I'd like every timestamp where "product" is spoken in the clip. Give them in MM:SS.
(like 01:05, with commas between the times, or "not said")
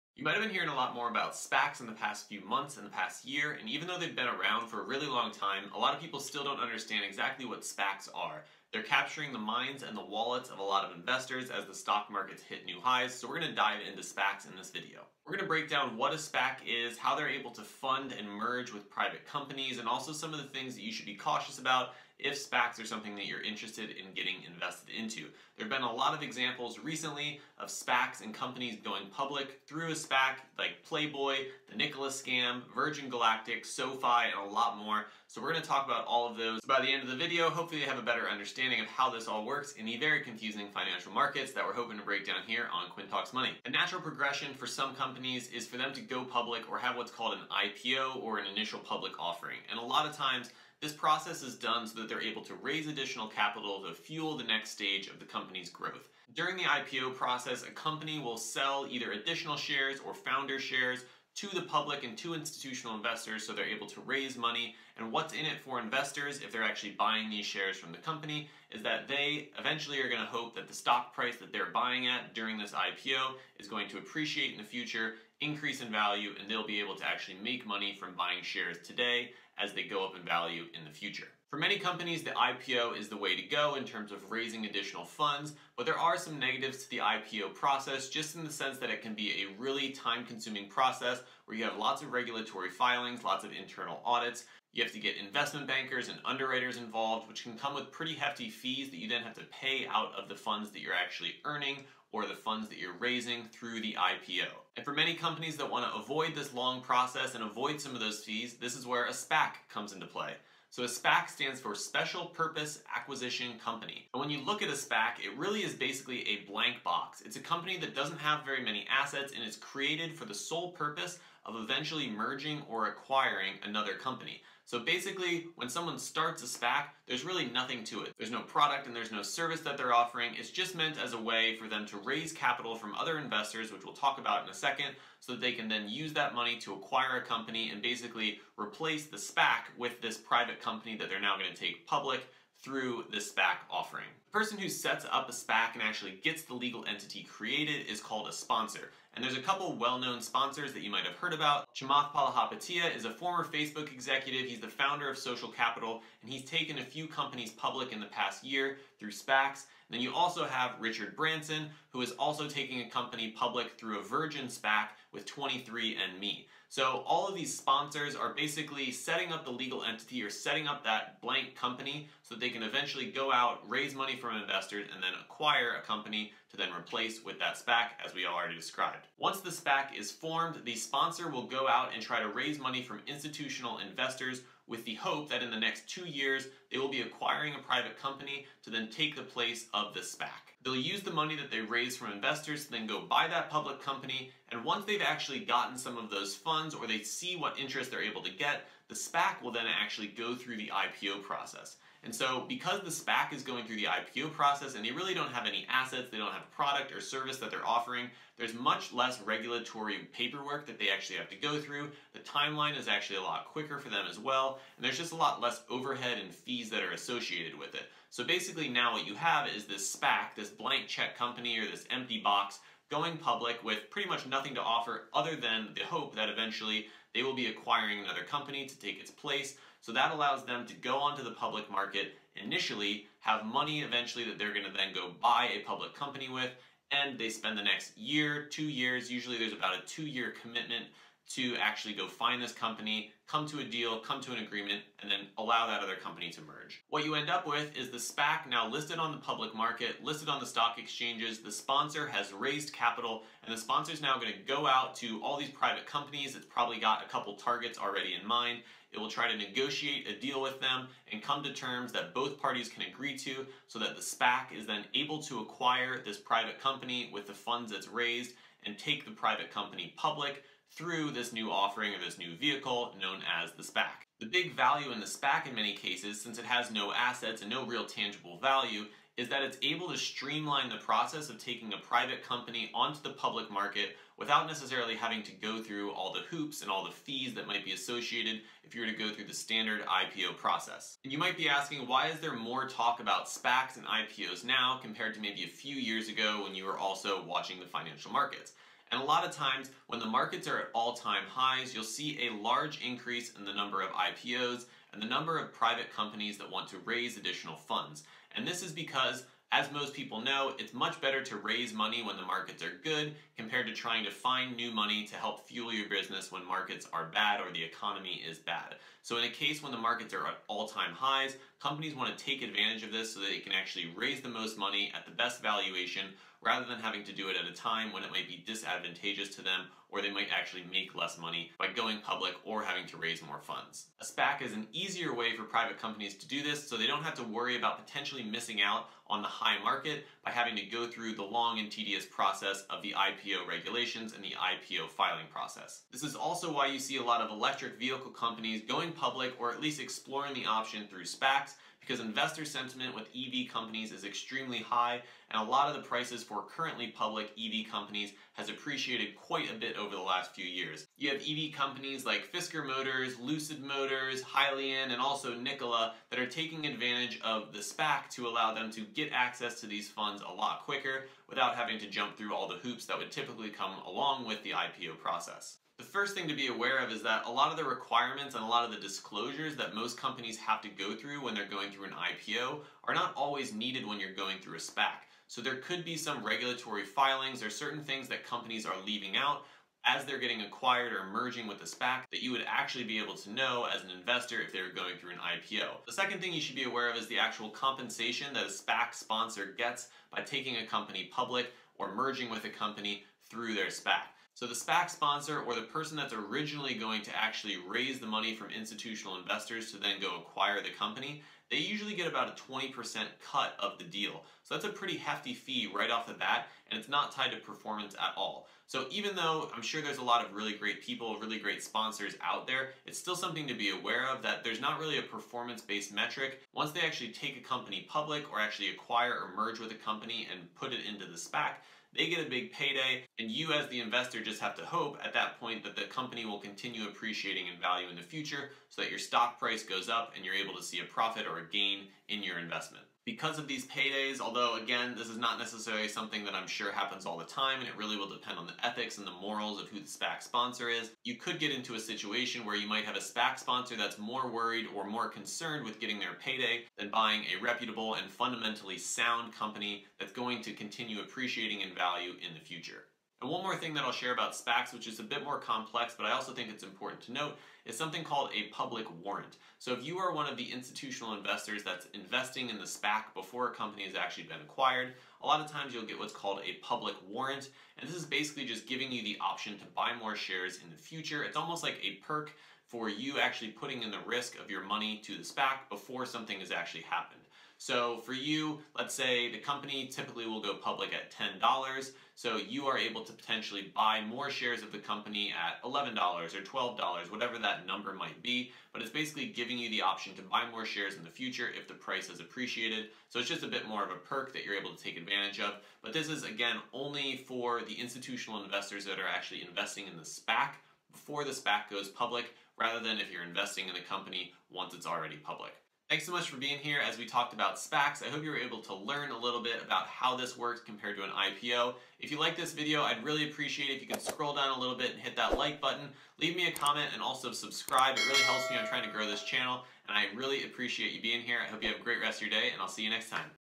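02:08, 03:26.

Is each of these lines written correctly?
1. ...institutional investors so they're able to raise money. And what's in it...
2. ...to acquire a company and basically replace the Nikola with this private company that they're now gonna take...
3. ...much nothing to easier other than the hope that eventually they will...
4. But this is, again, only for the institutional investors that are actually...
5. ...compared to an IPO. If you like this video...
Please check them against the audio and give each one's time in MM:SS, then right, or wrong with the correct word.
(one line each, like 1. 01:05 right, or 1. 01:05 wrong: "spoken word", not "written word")
1. 01:02 right
2. 02:16 wrong: "SPAC", not "Nikola"
3. 03:44 wrong: "offer", not "easier"
4. 08:25 right
5. 08:40 right.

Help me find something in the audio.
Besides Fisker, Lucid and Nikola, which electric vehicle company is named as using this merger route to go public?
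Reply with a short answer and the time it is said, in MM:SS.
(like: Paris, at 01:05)
Hyliion, at 06:04.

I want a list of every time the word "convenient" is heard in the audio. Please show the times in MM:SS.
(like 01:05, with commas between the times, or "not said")
not said.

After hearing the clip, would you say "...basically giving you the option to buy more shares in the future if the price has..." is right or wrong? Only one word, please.
right.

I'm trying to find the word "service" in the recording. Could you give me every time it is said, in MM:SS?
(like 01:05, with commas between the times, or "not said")
02:09, 03:26.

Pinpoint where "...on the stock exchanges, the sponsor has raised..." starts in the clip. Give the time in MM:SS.
04:10.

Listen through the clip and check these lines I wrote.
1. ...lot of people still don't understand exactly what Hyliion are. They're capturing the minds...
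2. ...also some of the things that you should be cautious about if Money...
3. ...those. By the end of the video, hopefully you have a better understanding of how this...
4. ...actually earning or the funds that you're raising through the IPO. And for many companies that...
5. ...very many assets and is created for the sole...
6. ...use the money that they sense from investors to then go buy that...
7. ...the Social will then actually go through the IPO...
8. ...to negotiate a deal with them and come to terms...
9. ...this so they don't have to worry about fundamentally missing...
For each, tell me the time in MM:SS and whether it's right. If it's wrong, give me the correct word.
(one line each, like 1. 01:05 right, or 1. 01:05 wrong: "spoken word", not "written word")
1. 00:05 wrong: "SPACs", not "Hyliion"
2. 00:19 wrong: "SPACs", not "Money"
3. 00:36 right
4. 01:40 right
5. 01:58 right
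6. 03:10 wrong: "raise", not "sense"
7. 03:18 wrong: "SPAC", not "Social"
8. 04:19 right
9. 05:36 wrong: "potentially", not "fundamentally".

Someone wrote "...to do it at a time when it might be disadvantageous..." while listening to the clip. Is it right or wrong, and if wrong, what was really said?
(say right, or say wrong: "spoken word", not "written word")
right.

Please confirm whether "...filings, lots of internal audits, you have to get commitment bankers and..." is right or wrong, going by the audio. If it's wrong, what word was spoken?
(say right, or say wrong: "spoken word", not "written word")
wrong: "investment", not "commitment".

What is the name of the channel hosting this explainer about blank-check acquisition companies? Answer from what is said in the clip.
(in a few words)
Quinn Talks Money.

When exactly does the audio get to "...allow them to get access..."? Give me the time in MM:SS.
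06:08.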